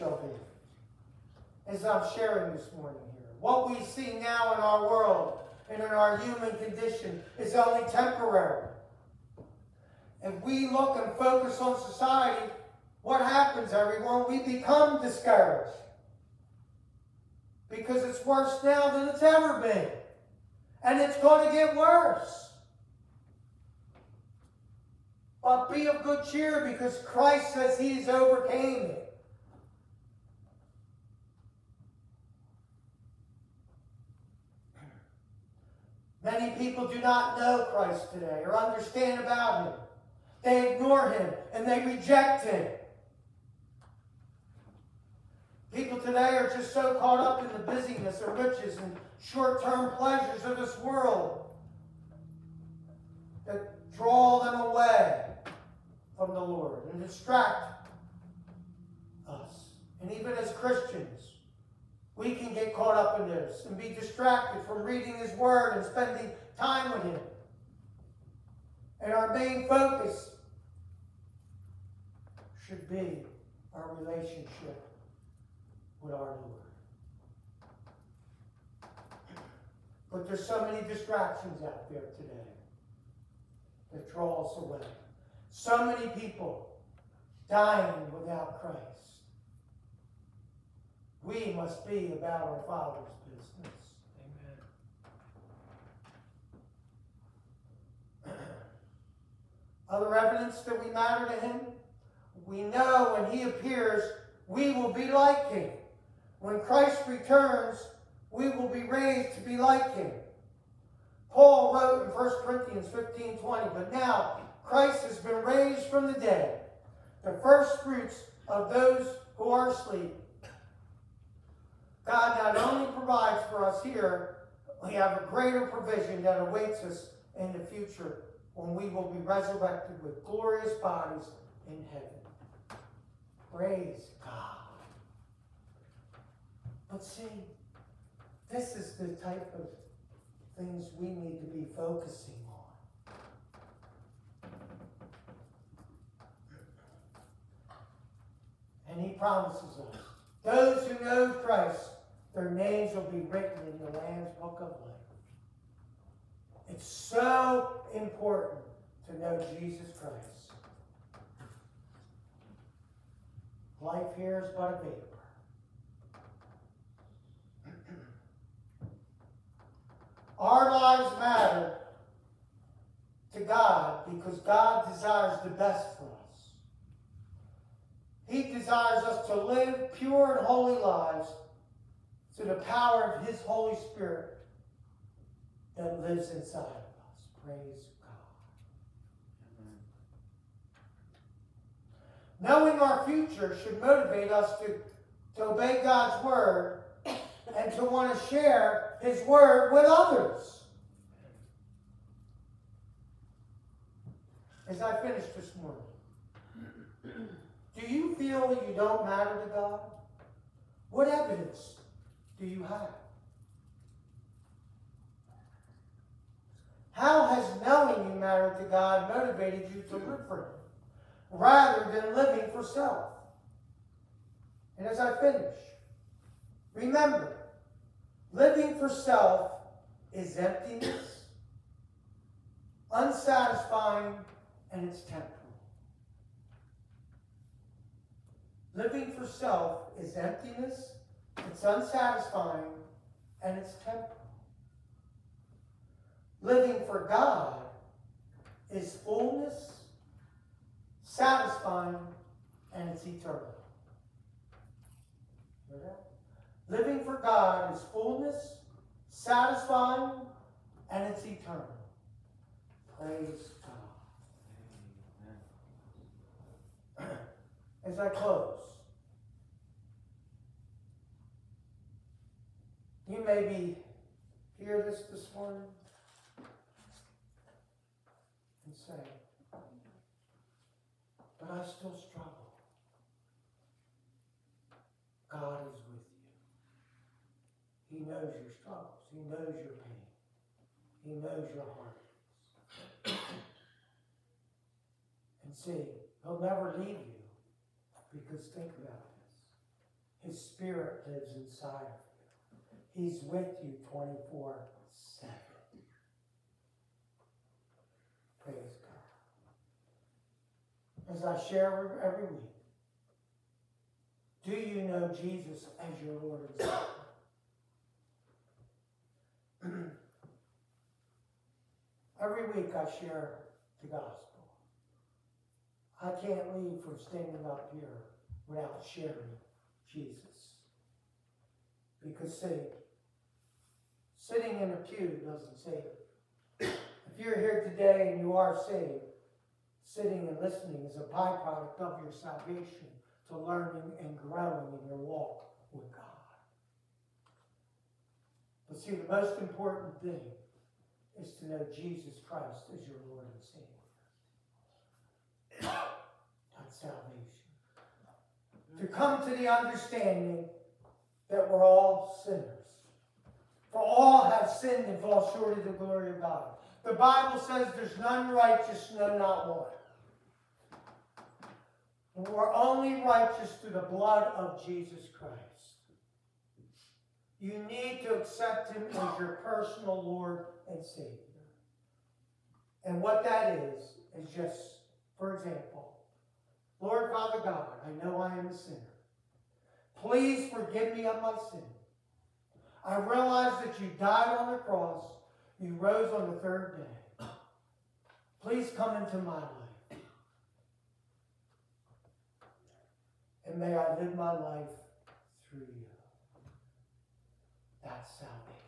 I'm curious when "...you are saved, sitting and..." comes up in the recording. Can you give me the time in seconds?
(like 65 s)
338 s.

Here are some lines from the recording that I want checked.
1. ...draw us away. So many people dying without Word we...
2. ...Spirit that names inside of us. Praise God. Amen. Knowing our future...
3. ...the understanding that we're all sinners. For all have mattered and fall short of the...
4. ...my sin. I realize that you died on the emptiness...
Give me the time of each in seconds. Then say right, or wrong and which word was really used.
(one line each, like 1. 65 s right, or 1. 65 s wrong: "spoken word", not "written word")
1. 84 s wrong: "Christ", not "Word"
2. 183 s wrong: "lives", not "names"
3. 359 s wrong: "sinned", not "mattered"
4. 391 s wrong: "cross", not "emptiness".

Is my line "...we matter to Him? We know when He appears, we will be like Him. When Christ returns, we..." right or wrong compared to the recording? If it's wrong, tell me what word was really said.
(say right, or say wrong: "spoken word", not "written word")
right.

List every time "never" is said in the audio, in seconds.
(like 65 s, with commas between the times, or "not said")
296 s.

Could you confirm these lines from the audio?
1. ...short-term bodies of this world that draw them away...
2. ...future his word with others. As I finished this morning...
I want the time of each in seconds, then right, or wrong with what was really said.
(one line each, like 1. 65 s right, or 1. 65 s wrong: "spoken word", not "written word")
1. 49 s wrong: "pleasures", not "bodies"
2. 198 s wrong: "share", not "future".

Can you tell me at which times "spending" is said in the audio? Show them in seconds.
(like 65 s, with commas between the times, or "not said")
65 s.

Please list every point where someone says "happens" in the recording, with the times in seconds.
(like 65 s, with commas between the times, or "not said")
13 s.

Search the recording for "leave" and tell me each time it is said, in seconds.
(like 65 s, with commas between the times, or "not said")
296 s, 326 s.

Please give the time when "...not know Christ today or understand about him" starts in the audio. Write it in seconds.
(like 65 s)
37 s.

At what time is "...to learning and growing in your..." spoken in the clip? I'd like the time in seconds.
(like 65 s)
343 s.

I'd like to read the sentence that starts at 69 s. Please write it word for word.
And our main focus should be our relationship with our Lord.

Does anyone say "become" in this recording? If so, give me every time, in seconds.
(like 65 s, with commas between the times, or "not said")
14 s.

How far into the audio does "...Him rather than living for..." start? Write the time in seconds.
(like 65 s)
220 s.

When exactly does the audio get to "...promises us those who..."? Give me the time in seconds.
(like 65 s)
149 s.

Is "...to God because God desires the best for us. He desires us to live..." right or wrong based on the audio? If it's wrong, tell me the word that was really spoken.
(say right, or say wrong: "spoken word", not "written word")
right.